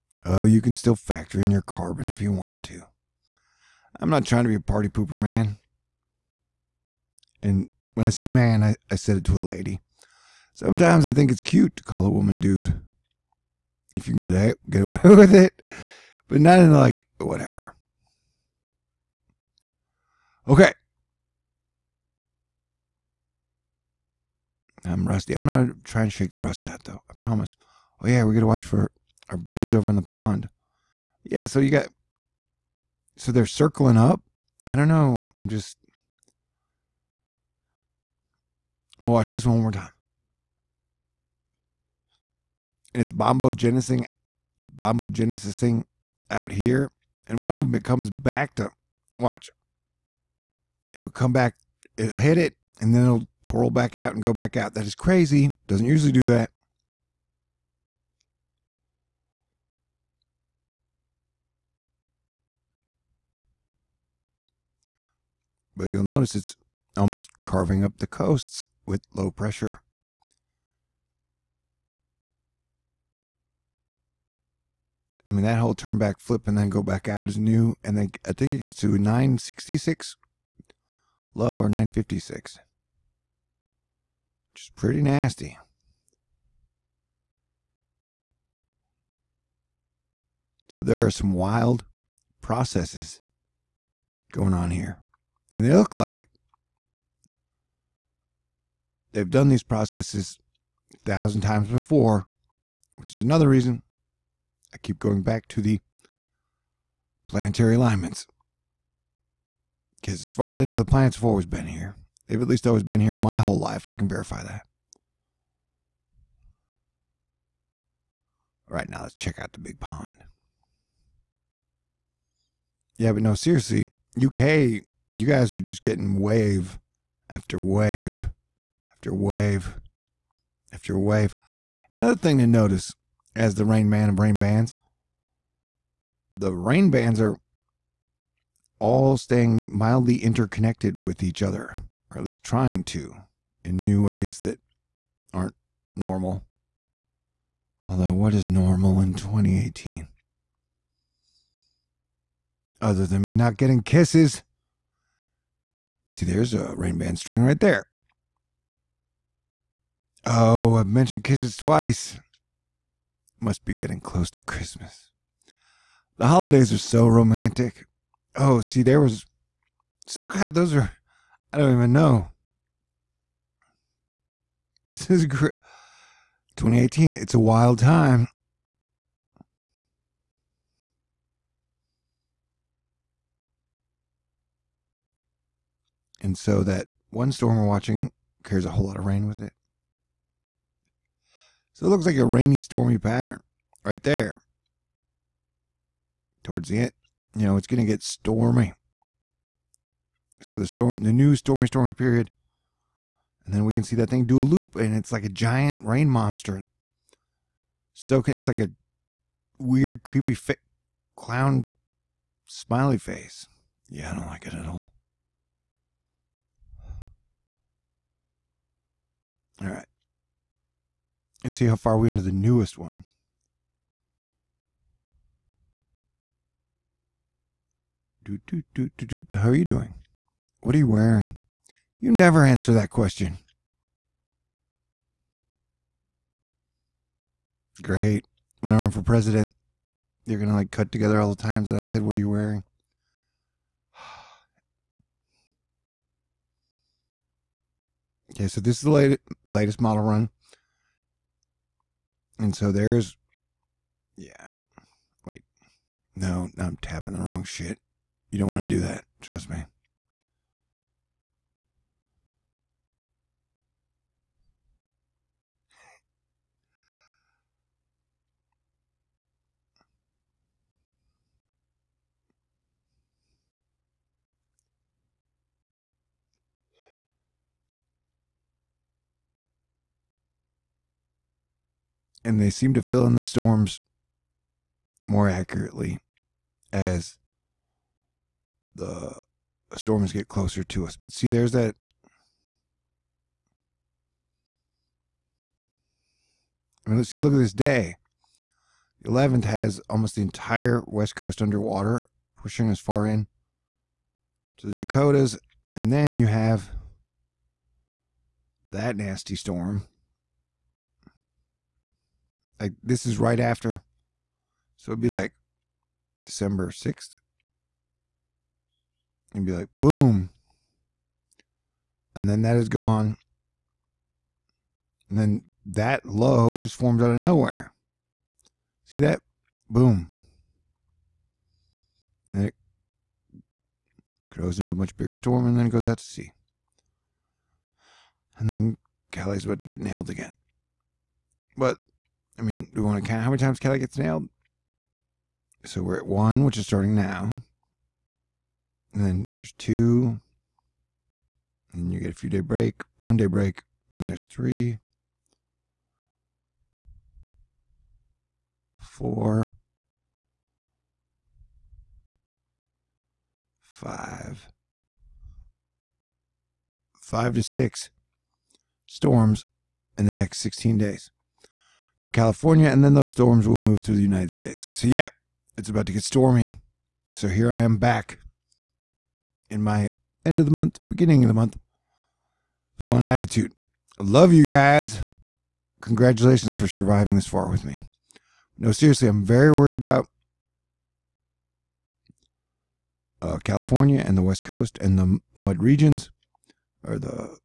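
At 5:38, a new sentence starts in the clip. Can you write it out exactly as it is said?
And then Cali's about to get nailed again.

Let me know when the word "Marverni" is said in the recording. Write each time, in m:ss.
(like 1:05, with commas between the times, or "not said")
not said.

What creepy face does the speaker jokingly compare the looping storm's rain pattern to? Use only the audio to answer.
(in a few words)
Creepy clown smiley face.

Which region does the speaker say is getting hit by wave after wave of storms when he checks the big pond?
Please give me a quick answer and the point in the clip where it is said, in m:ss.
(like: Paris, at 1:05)
UK, at 2:04.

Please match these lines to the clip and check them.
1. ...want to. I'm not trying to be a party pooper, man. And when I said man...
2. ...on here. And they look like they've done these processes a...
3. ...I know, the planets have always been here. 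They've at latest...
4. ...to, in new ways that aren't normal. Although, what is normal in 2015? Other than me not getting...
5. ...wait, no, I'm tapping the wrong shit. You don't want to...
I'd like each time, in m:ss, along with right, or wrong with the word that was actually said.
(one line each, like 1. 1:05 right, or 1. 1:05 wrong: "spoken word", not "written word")
1. 0:02 right
2. 1:34 right
3. 1:50 wrong: "least", not "latest"
4. 2:22 wrong: "2018", not "2015"
5. 4:15 right.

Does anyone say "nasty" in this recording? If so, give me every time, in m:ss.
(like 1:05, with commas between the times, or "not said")
1:25, 5:08.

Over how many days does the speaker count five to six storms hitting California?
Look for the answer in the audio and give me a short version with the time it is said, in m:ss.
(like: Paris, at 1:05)
16, at 6:10.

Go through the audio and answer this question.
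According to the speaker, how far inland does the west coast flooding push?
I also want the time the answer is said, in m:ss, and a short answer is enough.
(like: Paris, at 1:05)
Dakotas, at 5:04.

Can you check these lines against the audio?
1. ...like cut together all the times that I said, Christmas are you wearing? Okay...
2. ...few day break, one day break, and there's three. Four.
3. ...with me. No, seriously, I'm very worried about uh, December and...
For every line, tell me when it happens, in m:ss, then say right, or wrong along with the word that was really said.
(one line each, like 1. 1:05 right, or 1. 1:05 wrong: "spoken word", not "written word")
1. 4:00 wrong: "What", not "Christmas"
2. 5:52 right
3. 6:27 wrong: "California", not "December".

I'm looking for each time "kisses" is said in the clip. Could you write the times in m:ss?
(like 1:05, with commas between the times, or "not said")
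2:33, 2:41.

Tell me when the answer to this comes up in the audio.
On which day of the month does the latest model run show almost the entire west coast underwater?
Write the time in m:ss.
4:59.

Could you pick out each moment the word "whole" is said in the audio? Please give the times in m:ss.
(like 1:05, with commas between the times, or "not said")
1:15, 1:53, 3:08.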